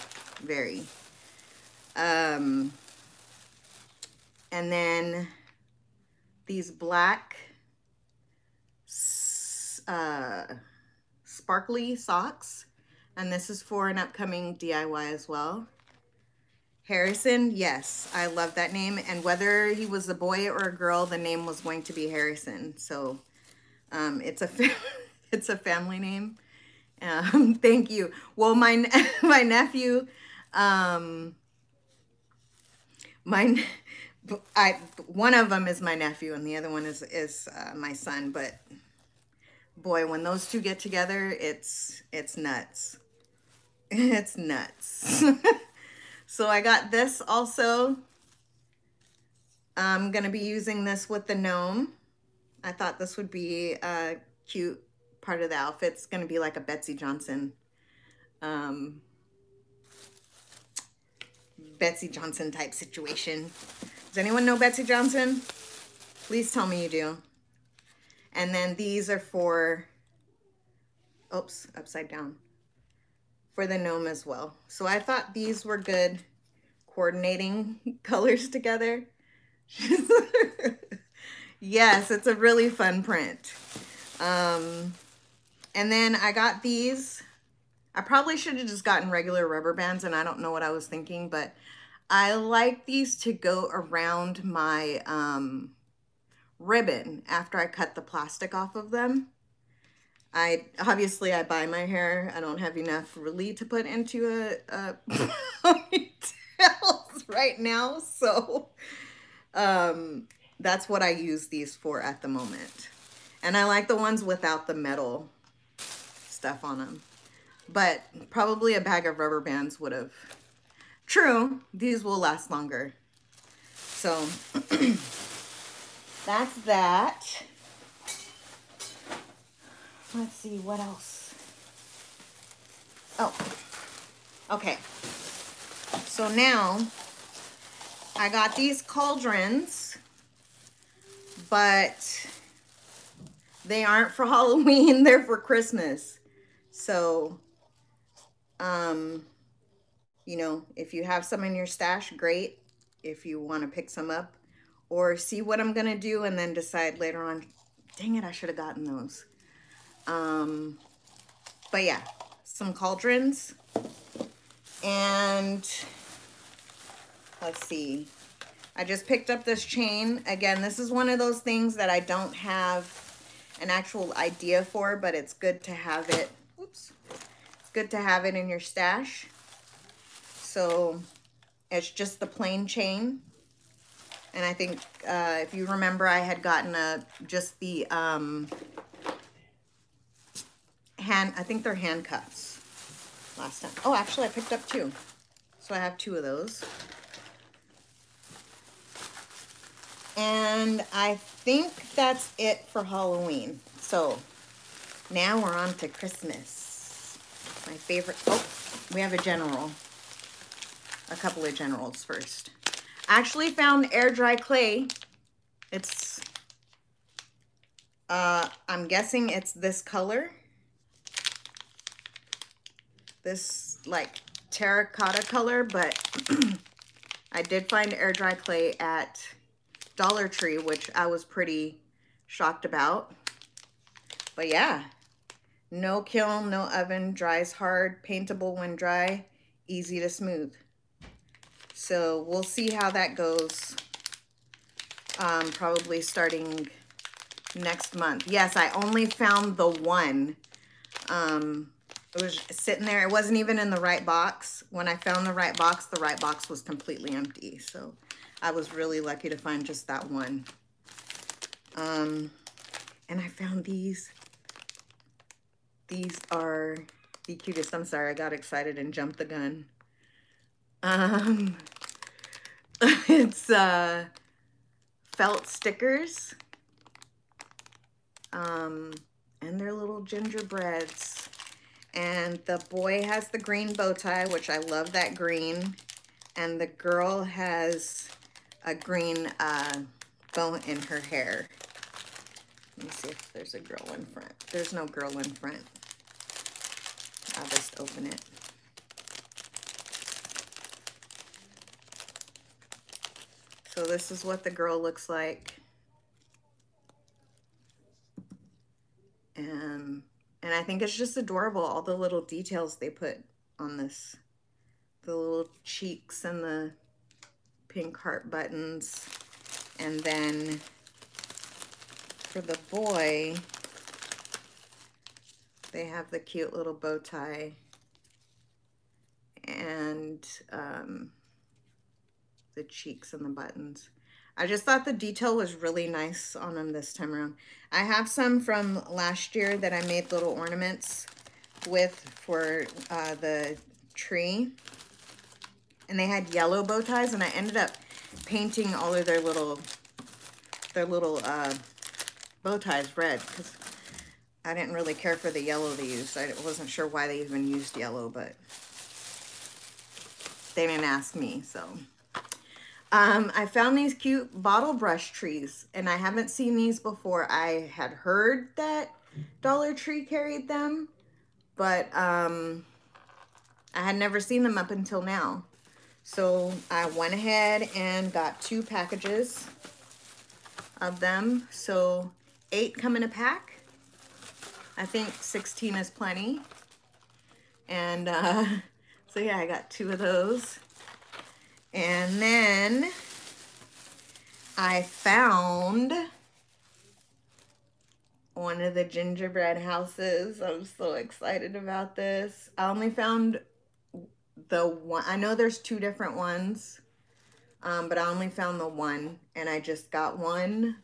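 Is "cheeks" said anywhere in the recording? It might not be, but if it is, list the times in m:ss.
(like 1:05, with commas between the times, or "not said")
5:15, 5:32.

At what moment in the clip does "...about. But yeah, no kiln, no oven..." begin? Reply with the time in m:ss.
3:52.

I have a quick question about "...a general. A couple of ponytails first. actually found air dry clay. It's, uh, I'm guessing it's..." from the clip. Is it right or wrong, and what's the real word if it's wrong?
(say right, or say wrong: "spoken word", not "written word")
wrong: "generals", not "ponytails".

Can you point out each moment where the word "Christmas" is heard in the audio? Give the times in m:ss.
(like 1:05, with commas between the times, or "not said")
2:25, 3:25.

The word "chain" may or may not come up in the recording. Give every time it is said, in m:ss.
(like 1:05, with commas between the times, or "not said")
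2:49, 3:02.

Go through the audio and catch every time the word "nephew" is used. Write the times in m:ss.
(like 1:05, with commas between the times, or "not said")
0:29, 0:35.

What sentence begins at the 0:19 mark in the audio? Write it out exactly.
And whether he was a boy or a girl, the name was going to be Harrison.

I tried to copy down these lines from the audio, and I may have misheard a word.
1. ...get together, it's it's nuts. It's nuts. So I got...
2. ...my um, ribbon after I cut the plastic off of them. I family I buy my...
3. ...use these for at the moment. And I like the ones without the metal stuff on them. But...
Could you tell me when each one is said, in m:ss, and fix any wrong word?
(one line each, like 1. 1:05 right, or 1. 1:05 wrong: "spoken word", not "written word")
1. 0:40 right
2. 1:34 wrong: "obviously", not "family"
3. 1:51 right.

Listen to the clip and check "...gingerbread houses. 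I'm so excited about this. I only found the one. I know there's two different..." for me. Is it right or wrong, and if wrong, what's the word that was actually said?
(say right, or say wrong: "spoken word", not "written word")
right.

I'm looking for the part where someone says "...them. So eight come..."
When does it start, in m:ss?
6:21.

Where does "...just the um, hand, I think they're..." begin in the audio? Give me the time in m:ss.
3:07.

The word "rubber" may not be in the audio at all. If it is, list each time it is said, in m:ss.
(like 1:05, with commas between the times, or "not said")
1:29, 1:59.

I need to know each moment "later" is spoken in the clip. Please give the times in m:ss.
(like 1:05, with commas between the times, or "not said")
2:36.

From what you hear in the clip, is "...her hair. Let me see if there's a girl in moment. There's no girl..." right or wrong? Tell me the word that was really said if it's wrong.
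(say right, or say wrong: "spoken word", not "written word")
wrong: "front", not "moment".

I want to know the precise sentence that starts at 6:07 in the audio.
I had heard that Dollar Tree carried them, but um, I had never seen them up until now.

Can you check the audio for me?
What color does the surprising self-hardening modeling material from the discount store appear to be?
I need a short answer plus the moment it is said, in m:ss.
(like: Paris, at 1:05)
terracotta, at 3:44.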